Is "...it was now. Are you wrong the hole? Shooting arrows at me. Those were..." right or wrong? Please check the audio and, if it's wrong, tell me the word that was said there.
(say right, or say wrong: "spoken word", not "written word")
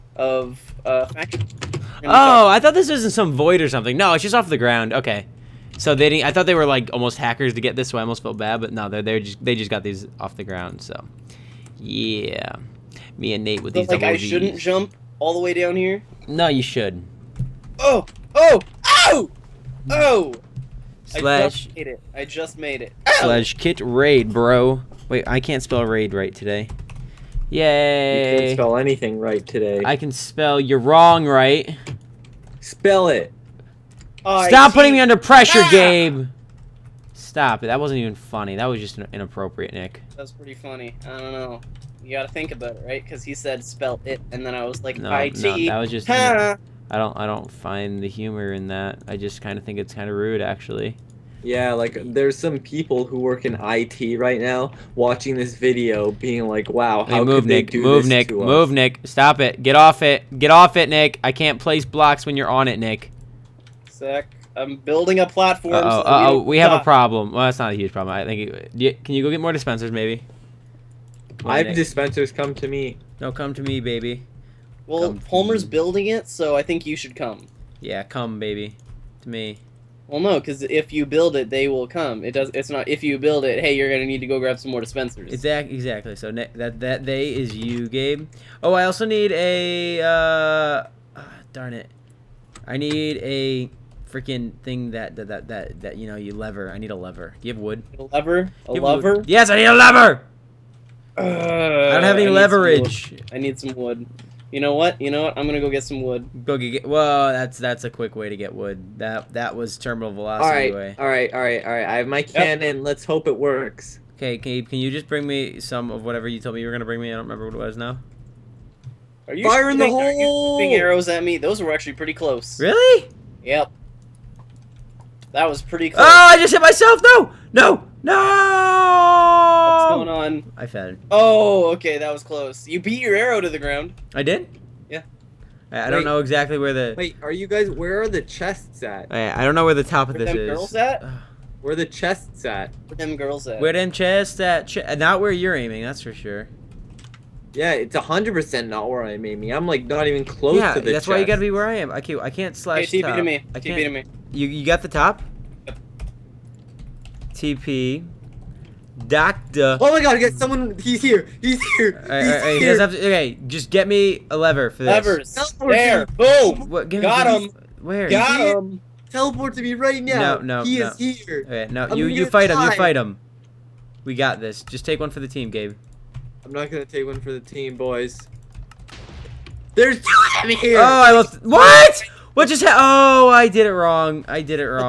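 wrong: "firing", not "wrong".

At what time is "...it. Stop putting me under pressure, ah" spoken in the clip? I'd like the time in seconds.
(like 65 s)
33 s.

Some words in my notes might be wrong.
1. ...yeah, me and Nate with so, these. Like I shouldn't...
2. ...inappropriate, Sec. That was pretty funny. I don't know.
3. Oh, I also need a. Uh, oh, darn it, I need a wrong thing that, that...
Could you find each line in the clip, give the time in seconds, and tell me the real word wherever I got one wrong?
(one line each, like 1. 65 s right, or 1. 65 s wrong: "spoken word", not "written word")
1. 11 s right
2. 39 s wrong: "Nick", not "Sec"
3. 88 s wrong: "freaking", not "wrong".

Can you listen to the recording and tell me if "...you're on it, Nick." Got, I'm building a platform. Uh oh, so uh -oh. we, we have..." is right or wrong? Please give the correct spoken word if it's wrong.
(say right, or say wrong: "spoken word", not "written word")
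wrong: "Sec", not "Got".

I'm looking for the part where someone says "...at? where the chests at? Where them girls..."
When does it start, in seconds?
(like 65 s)
140 s.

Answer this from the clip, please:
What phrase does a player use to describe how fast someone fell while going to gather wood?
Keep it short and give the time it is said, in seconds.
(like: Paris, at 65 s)
Terminal velocity, at 109 s.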